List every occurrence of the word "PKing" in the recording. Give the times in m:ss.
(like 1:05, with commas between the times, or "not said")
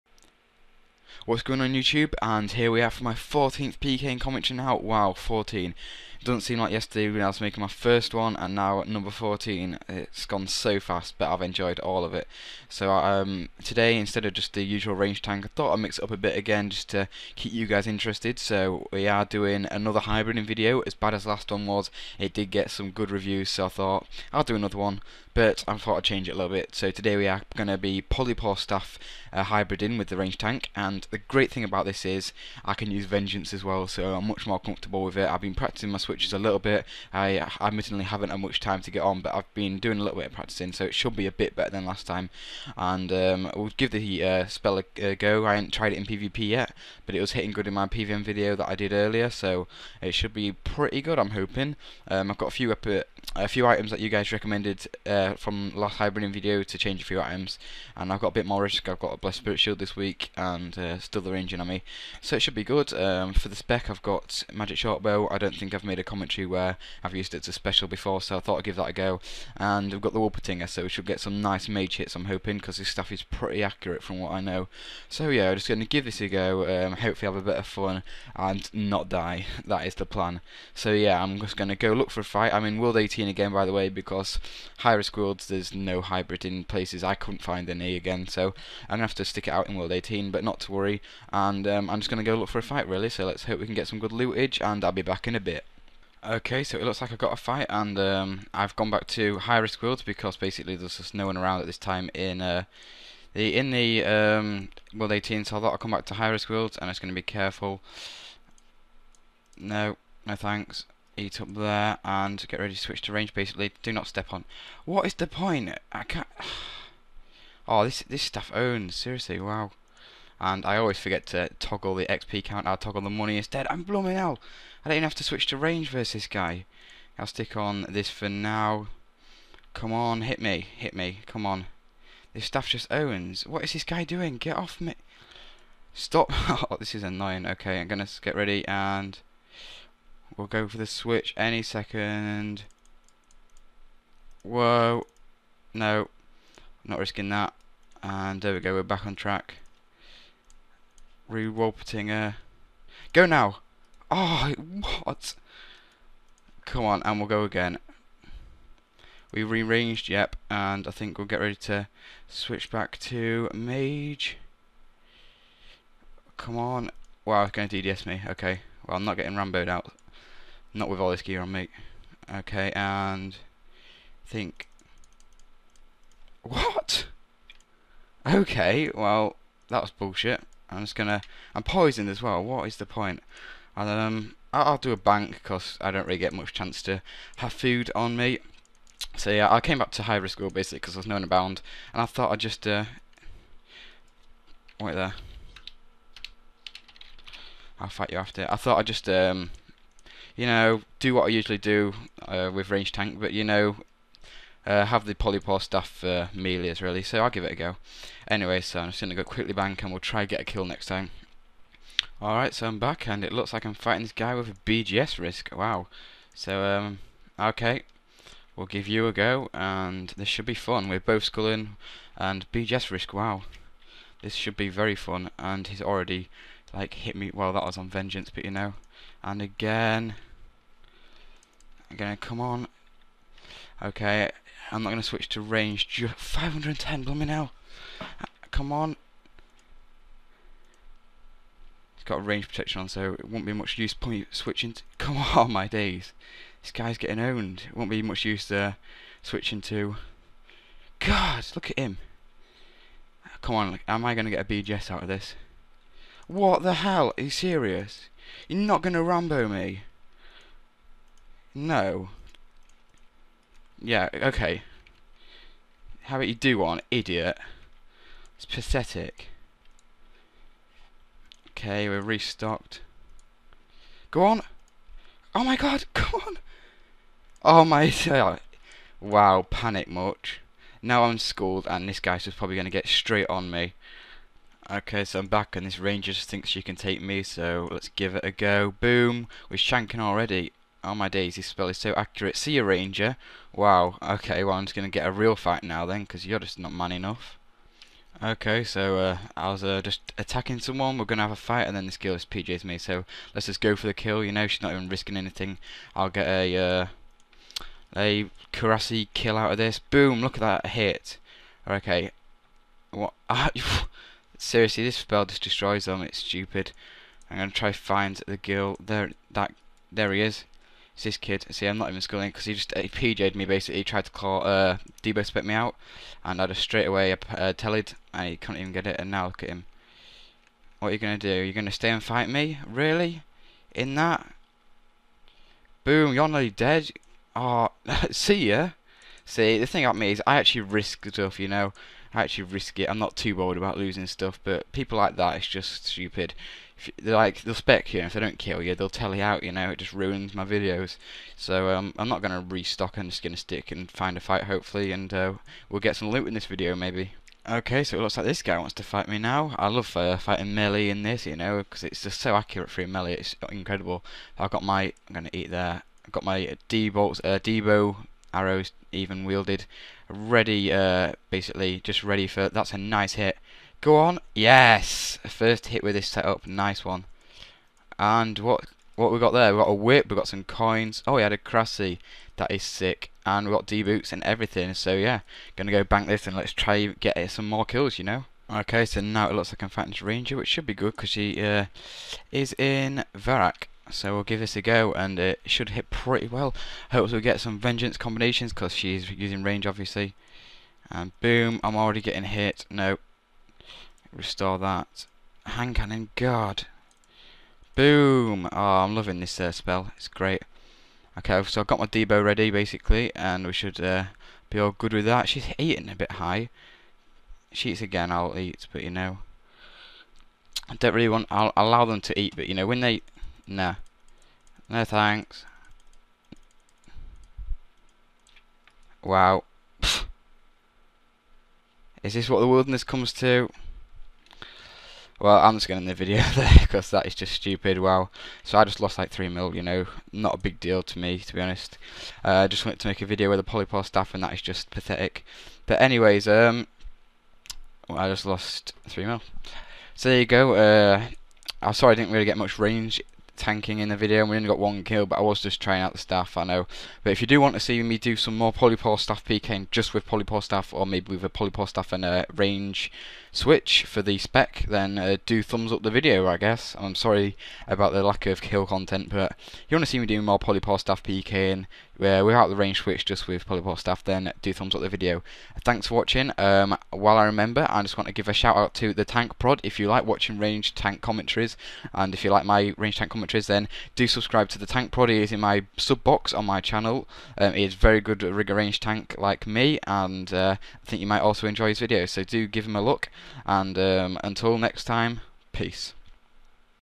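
7:39, 7:51.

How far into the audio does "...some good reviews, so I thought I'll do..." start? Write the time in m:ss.
0:22.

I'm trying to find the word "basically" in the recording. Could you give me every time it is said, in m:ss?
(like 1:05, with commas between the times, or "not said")
1:40, 1:53, 3:10, 5:23, 6:11, 6:52.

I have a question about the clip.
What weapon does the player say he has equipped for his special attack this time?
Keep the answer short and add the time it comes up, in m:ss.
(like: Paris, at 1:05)
Magic shortbow, at 1:04.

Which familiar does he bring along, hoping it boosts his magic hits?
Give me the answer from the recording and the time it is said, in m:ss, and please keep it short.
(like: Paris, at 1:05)
Wolpertinger, at 1:10.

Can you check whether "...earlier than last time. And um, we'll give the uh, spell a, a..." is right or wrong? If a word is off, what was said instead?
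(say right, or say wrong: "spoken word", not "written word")
wrong: "better", not "earlier".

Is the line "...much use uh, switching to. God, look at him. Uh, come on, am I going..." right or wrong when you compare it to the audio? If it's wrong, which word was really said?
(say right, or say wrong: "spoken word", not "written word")
right.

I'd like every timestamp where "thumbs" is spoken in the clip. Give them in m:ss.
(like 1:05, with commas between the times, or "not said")
7:45, 7:54.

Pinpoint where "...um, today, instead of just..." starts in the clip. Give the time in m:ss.
0:12.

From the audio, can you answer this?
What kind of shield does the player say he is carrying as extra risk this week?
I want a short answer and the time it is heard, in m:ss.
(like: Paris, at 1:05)
Blessed Spirit Shield, at 0:59.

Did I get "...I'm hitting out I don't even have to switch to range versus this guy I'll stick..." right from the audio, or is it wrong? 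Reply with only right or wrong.
wrong.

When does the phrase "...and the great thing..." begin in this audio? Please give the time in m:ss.
0:30.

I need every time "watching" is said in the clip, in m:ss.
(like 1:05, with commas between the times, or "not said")
7:55, 8:00.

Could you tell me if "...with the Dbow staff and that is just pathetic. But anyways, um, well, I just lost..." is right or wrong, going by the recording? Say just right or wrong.
wrong.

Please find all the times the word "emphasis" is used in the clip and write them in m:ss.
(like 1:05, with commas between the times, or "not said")
not said.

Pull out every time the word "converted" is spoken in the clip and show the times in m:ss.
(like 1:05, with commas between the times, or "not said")
not said.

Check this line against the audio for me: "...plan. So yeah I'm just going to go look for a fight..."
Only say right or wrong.
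right.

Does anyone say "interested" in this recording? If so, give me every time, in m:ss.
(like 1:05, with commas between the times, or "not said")
0:17.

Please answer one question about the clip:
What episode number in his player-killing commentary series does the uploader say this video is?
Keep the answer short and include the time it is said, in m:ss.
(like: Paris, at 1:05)
14th, at 0:03.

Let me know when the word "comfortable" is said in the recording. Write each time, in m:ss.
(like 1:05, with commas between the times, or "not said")
0:34.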